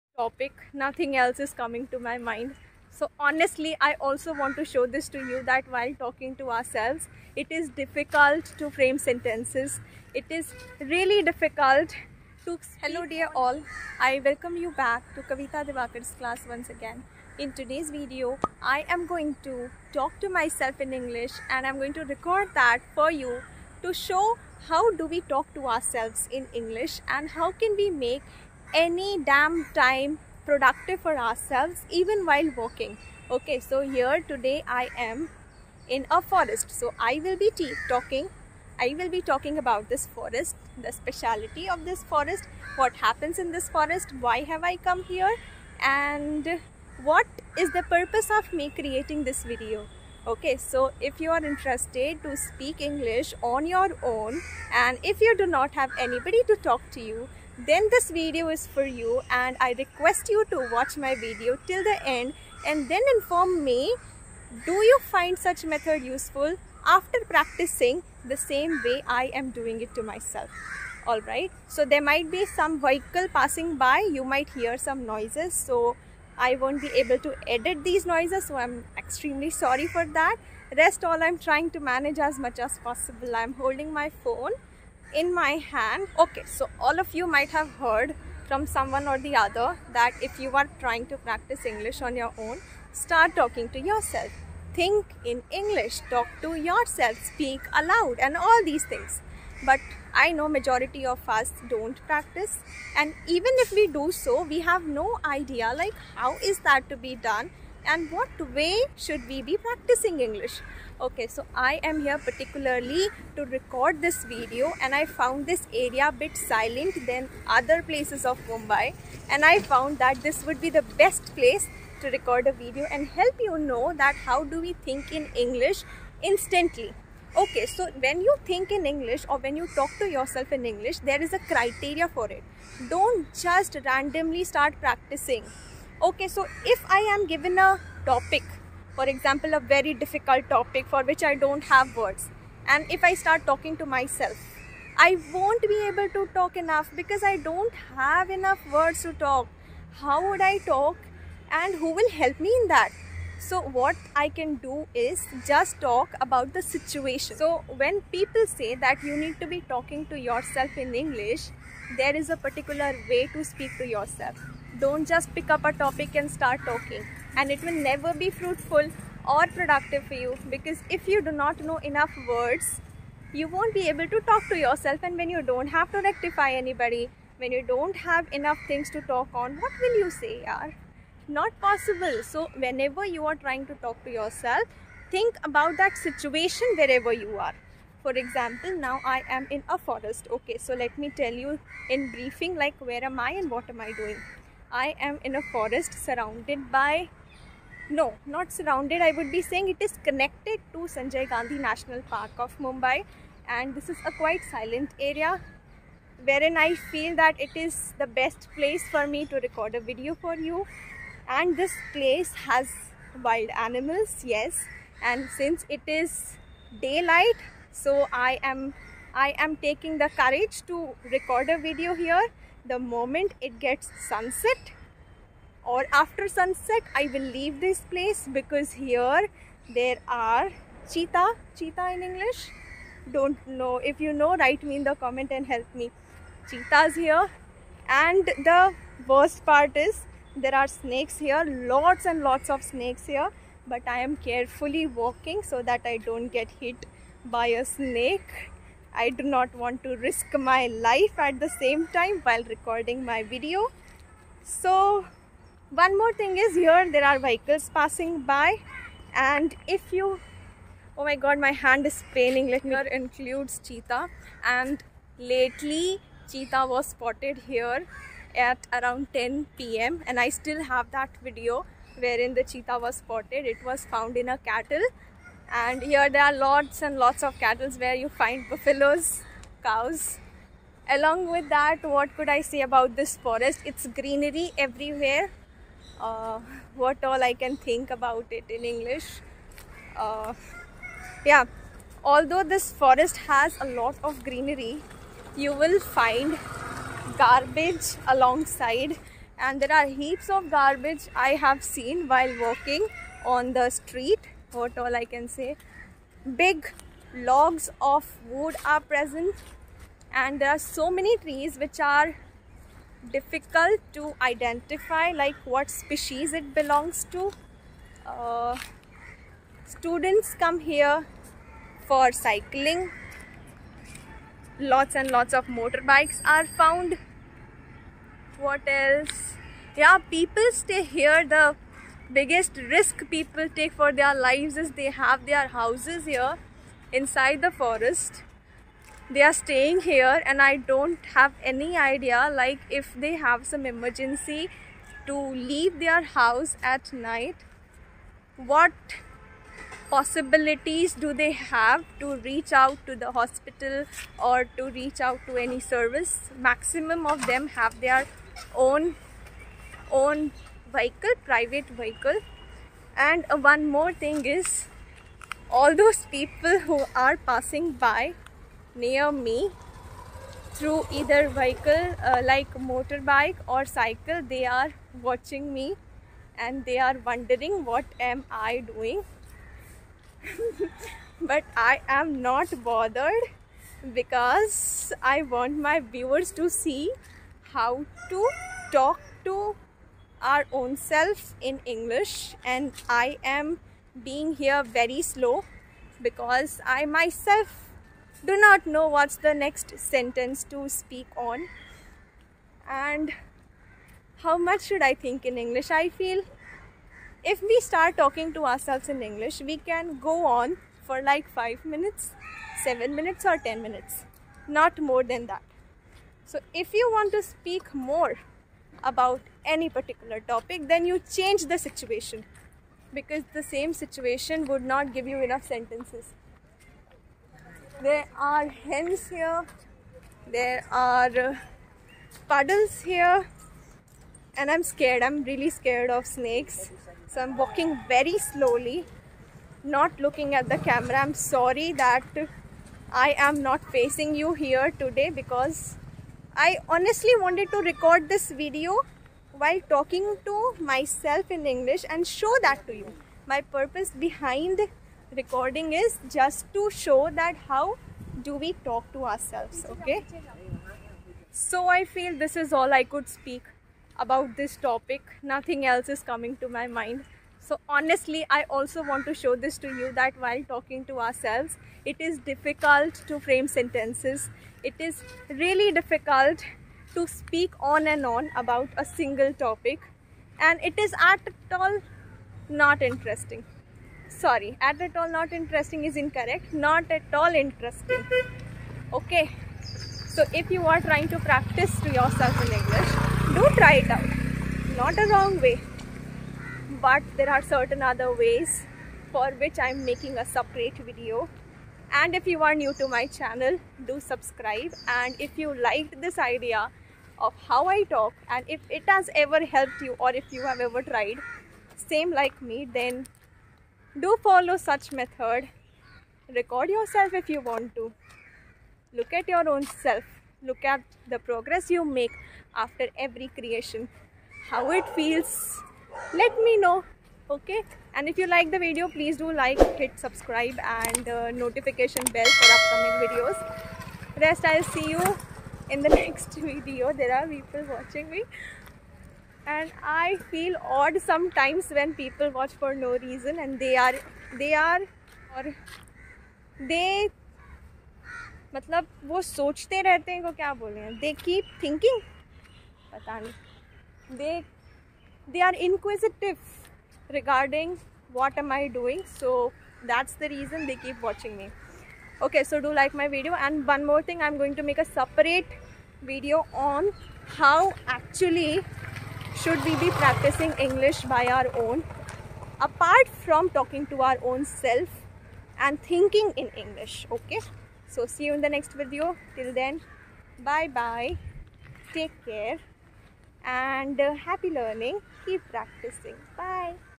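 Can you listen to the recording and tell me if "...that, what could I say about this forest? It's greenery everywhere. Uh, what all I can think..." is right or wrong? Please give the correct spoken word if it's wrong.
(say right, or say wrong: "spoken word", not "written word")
right.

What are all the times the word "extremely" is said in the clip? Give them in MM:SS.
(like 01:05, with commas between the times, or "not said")
01:18.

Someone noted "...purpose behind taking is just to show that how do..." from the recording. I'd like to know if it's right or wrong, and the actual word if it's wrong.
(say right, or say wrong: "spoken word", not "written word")
wrong: "recording", not "taking".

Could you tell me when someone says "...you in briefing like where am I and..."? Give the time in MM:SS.
03:11.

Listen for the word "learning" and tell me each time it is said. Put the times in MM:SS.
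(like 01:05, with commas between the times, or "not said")
09:44.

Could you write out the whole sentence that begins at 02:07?
Okay, so when you think in English or when you talk to yourself in English, there is a criteria for it.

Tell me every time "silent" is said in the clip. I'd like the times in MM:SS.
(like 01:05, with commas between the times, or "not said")
01:56, 03:24.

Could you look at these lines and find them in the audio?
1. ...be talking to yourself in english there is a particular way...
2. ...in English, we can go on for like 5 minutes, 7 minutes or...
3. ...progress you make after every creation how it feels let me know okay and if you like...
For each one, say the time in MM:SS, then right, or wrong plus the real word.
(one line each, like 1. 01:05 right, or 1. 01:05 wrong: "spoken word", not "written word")
1. 02:39 right
2. 06:48 right
3. 08:41 right.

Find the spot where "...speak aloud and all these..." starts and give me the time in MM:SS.
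01:37.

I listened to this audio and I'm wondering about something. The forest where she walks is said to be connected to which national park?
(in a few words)
Sanjay Gandhi National Park.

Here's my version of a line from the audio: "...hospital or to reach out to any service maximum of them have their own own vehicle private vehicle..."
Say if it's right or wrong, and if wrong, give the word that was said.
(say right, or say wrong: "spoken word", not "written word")
right.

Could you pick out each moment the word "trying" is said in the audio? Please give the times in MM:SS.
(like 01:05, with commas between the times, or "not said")
01:21, 01:30, 03:03, 08:10.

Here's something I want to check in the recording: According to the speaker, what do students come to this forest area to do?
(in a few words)
Cycling.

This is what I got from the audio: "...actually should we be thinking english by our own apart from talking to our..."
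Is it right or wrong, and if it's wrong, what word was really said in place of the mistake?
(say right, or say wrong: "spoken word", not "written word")
wrong: "practicing", not "thinking".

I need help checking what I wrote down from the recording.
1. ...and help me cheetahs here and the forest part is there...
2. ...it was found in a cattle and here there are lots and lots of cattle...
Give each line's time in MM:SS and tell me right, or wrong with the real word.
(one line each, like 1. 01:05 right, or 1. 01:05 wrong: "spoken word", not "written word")
1. 03:55 wrong: "worst", not "forest"
2. 04:33 right.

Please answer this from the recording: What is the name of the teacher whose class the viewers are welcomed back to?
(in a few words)
Kavita Diwakar.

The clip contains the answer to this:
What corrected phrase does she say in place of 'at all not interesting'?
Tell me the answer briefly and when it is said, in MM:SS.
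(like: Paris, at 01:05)
not at all interesting, at 08:06.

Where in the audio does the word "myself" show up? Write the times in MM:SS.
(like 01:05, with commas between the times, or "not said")
00:20, 01:10, 02:23, 06:36, 07:30.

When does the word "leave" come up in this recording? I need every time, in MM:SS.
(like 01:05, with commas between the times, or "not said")
03:47, 05:45.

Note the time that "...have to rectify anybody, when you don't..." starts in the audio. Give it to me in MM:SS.
02:55.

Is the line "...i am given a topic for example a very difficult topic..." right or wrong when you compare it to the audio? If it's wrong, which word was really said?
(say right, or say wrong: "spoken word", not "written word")
right.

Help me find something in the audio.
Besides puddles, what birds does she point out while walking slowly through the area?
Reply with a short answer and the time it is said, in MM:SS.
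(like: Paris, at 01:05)
Hens, at 07:08.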